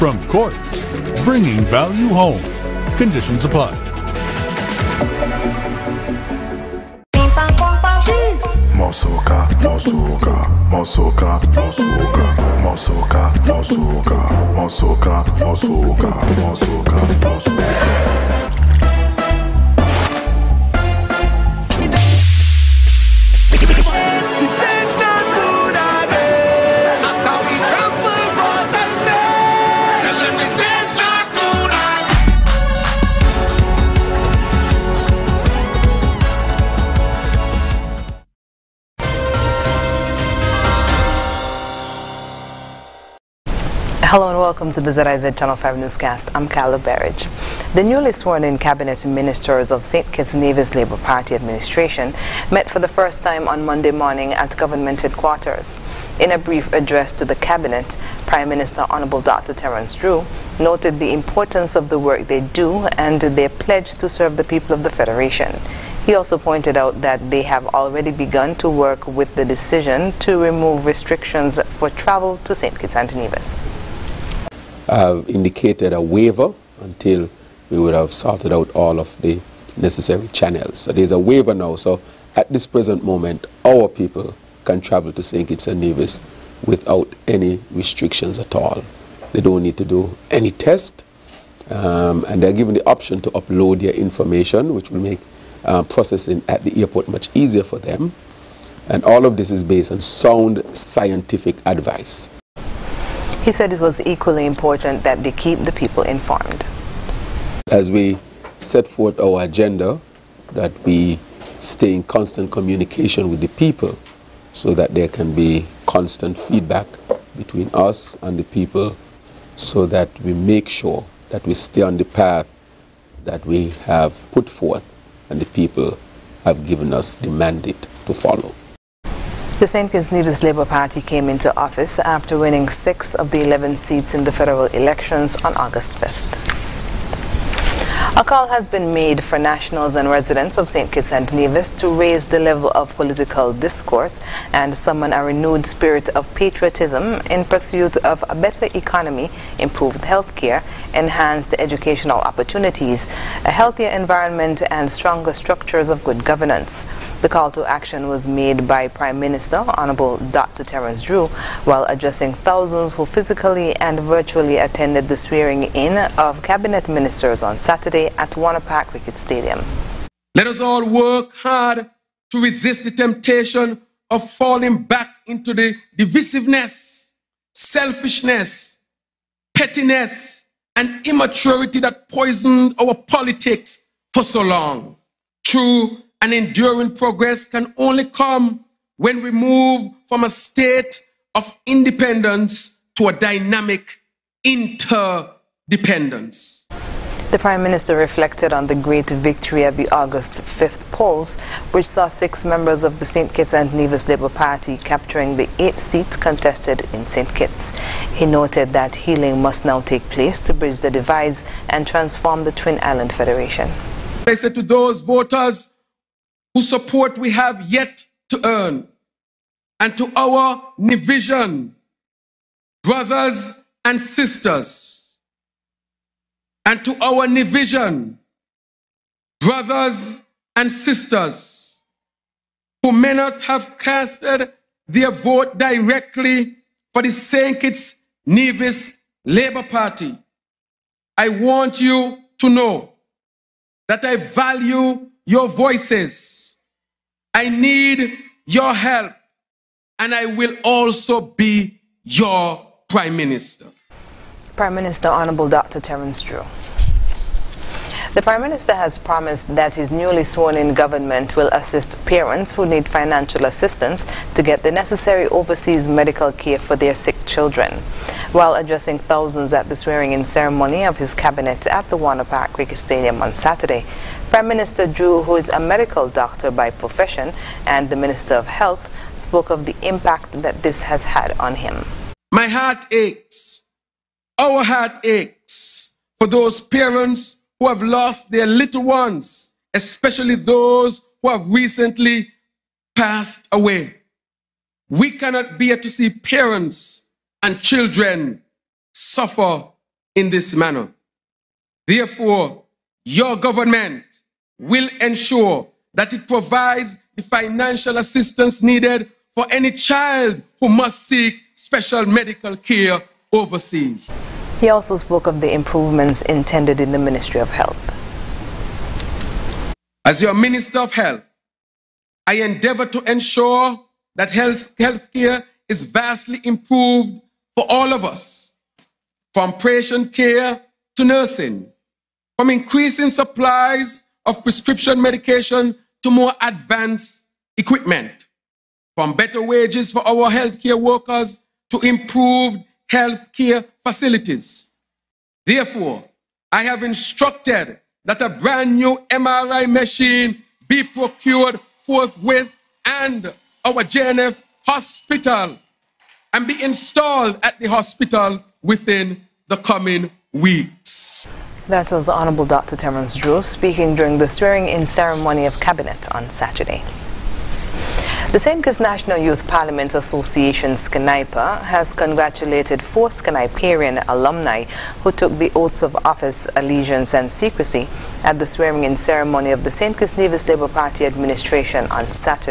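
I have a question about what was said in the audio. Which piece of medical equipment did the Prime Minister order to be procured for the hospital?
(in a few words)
MRI machine.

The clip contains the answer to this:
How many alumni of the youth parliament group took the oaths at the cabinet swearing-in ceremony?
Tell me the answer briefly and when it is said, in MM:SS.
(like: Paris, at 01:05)
4, at 06:12.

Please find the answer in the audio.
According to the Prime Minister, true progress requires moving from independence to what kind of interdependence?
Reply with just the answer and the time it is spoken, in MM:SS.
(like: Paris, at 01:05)
Dynamic, at 03:13.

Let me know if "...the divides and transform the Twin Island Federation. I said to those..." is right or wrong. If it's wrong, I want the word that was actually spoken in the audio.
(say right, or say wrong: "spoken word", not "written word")
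right.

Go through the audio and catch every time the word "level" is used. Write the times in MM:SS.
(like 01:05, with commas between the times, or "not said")
02:22.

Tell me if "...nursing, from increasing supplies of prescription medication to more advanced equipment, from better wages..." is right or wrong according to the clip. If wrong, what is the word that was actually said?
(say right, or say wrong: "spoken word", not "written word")
right.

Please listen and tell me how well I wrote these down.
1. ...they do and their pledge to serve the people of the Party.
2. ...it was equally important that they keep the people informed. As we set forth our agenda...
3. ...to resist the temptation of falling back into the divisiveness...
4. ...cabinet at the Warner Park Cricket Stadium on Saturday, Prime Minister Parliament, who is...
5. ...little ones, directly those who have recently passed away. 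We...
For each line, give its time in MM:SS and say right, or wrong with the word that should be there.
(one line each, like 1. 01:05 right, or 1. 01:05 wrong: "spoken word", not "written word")
1. 01:02 wrong: "Federation", not "Party"
2. 01:43 right
3. 02:52 right
4. 04:31 wrong: "Drew", not "Parliament"
5. 04:48 wrong: "especially", not "directly".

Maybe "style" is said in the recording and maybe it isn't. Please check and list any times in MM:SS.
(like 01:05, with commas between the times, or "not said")
not said.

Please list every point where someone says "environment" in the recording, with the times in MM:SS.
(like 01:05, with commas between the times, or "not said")
02:33.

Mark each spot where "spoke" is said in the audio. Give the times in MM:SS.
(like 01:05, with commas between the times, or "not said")
04:39, 05:14.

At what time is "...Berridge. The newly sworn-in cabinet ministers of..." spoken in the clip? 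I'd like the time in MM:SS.
00:46.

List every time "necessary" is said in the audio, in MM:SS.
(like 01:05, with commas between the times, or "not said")
01:19, 04:24.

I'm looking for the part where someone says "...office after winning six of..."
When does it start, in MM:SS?
02:11.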